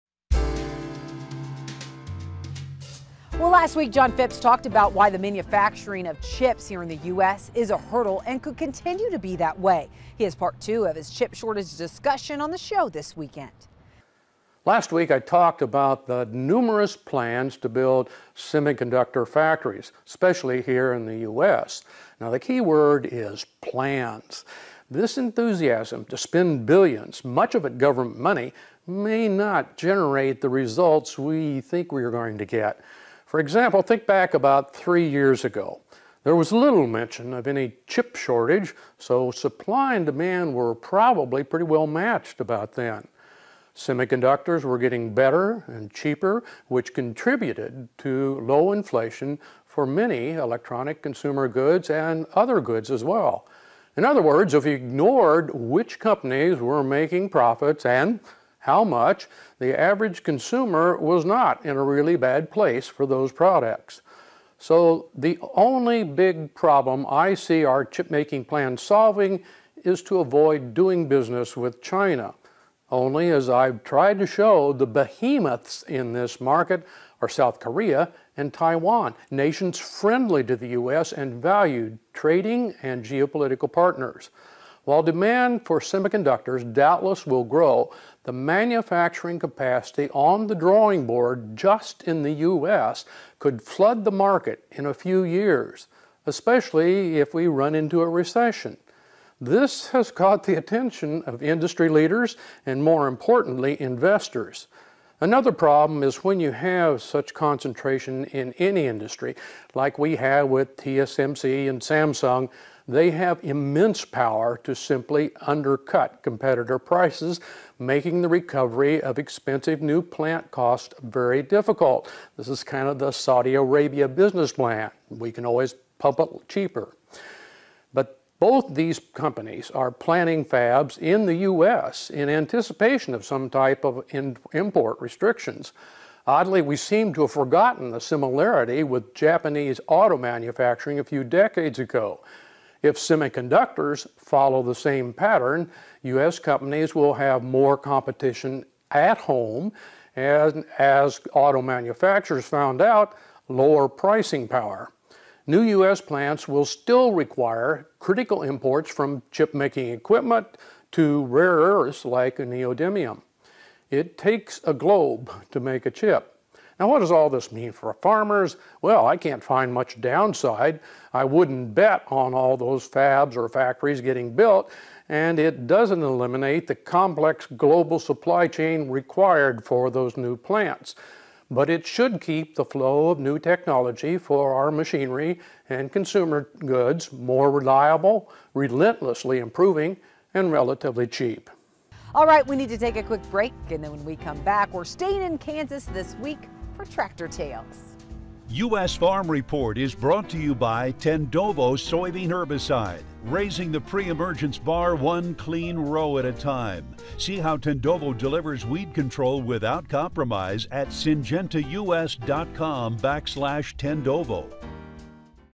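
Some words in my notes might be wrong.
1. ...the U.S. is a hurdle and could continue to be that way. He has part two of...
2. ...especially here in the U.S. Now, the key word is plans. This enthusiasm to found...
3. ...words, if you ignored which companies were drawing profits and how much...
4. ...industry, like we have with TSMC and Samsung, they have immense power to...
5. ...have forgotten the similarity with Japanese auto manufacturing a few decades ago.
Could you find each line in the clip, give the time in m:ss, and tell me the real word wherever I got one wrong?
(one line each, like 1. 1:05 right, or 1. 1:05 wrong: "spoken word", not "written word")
1. 0:06 right
2. 0:20 wrong: "spend", not "found"
3. 0:54 wrong: "making", not "drawing"
4. 1:48 right
5. 2:17 right.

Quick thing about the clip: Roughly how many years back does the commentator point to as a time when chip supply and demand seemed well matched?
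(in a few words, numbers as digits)
3 years.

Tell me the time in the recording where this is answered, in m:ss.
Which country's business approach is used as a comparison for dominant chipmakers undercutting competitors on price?
2:03.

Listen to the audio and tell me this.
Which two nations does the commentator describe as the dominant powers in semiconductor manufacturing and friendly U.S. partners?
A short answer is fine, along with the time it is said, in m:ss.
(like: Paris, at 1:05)
South Korea and Taiwan, at 1:17.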